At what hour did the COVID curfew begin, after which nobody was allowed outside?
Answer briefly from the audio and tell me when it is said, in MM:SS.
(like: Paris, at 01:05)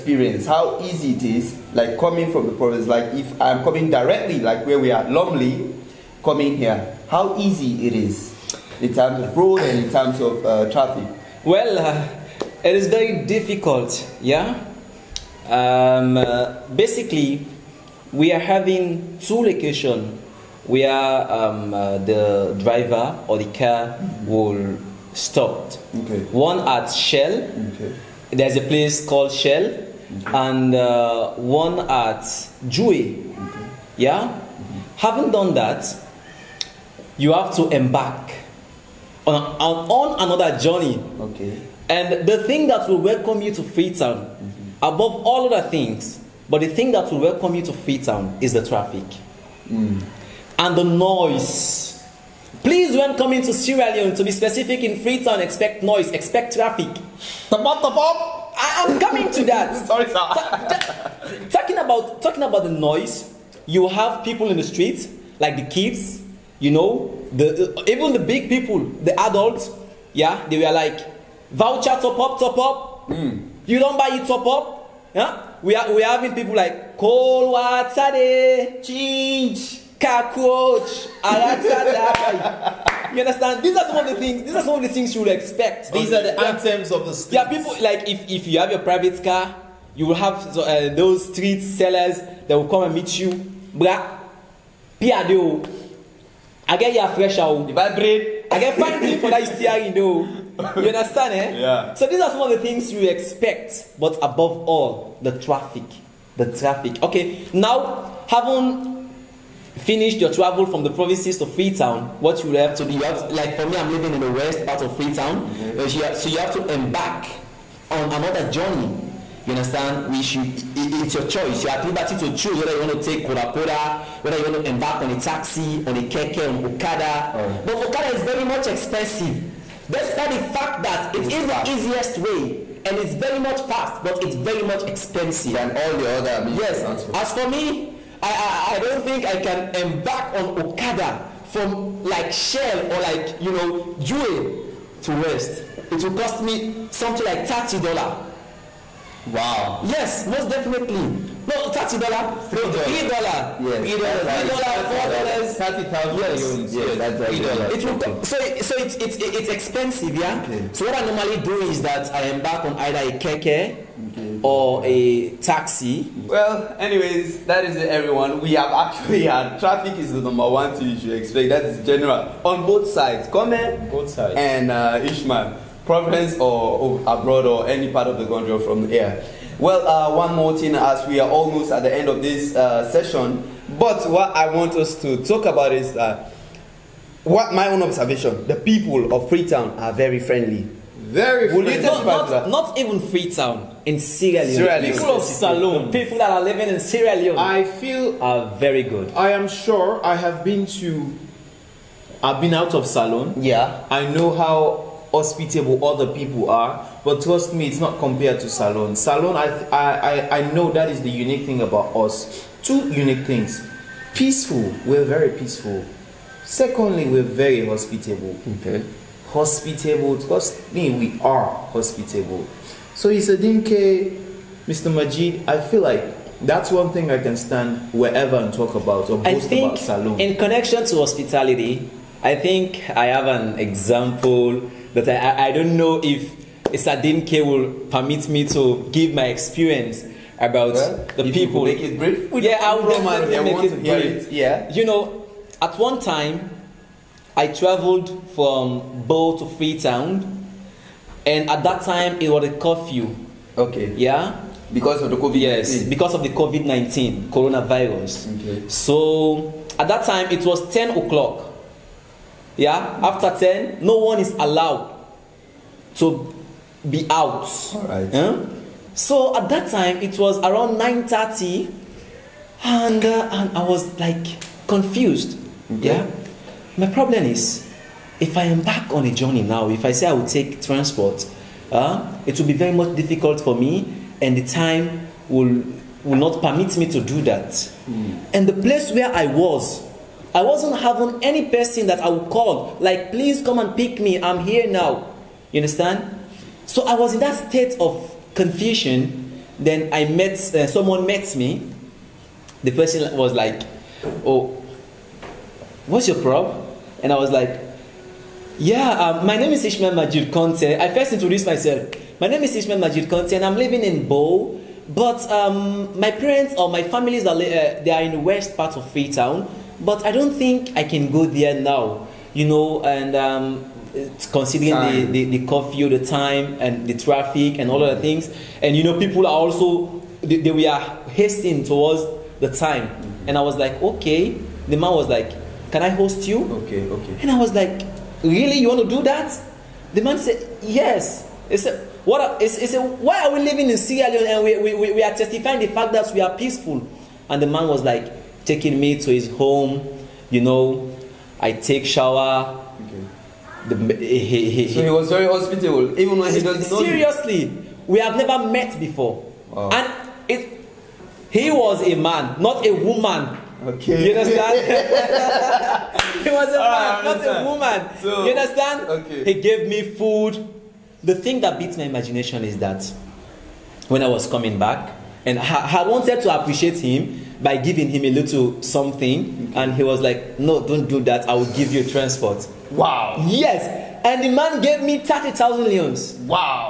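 10 o'clock, at 04:20.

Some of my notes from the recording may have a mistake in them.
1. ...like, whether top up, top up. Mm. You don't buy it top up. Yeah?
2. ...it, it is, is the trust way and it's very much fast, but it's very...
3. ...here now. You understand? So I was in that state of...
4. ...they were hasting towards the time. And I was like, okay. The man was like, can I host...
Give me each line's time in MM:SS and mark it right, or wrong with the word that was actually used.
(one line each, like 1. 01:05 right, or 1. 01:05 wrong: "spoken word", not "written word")
1. 01:10 wrong: "voucher", not "whether"
2. 02:11 wrong: "easiest", not "trust"
3. 04:54 right
4. 05:30 right.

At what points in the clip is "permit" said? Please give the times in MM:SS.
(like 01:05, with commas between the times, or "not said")
03:57, 04:46.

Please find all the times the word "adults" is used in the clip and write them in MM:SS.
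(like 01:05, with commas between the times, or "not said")
01:09.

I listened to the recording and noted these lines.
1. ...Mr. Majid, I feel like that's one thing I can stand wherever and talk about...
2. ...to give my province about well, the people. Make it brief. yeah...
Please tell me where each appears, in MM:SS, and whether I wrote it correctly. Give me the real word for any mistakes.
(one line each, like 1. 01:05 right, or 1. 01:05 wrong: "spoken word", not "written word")
1. 03:44 right
2. 03:58 wrong: "experience", not "province".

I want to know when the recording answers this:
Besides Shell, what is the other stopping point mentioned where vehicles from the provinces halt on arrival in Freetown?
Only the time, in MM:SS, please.
00:32.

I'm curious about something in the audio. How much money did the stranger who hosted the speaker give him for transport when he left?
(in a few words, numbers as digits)
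30,000 leones.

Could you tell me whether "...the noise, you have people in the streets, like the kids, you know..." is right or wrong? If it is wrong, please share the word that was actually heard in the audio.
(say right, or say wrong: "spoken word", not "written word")
right.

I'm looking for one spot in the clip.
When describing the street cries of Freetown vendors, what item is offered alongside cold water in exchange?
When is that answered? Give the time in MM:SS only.
01:18.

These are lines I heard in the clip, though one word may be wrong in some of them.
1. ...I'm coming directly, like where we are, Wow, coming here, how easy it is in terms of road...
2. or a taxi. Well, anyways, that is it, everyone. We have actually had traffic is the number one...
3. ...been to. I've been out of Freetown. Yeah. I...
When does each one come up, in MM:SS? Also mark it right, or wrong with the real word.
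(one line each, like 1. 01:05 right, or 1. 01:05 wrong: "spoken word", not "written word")
1. 00:03 wrong: "Lumley", not "Wow"
2. 02:44 right
3. 03:20 wrong: "Saloon", not "Freetown".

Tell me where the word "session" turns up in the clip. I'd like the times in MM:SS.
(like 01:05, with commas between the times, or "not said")
03:02.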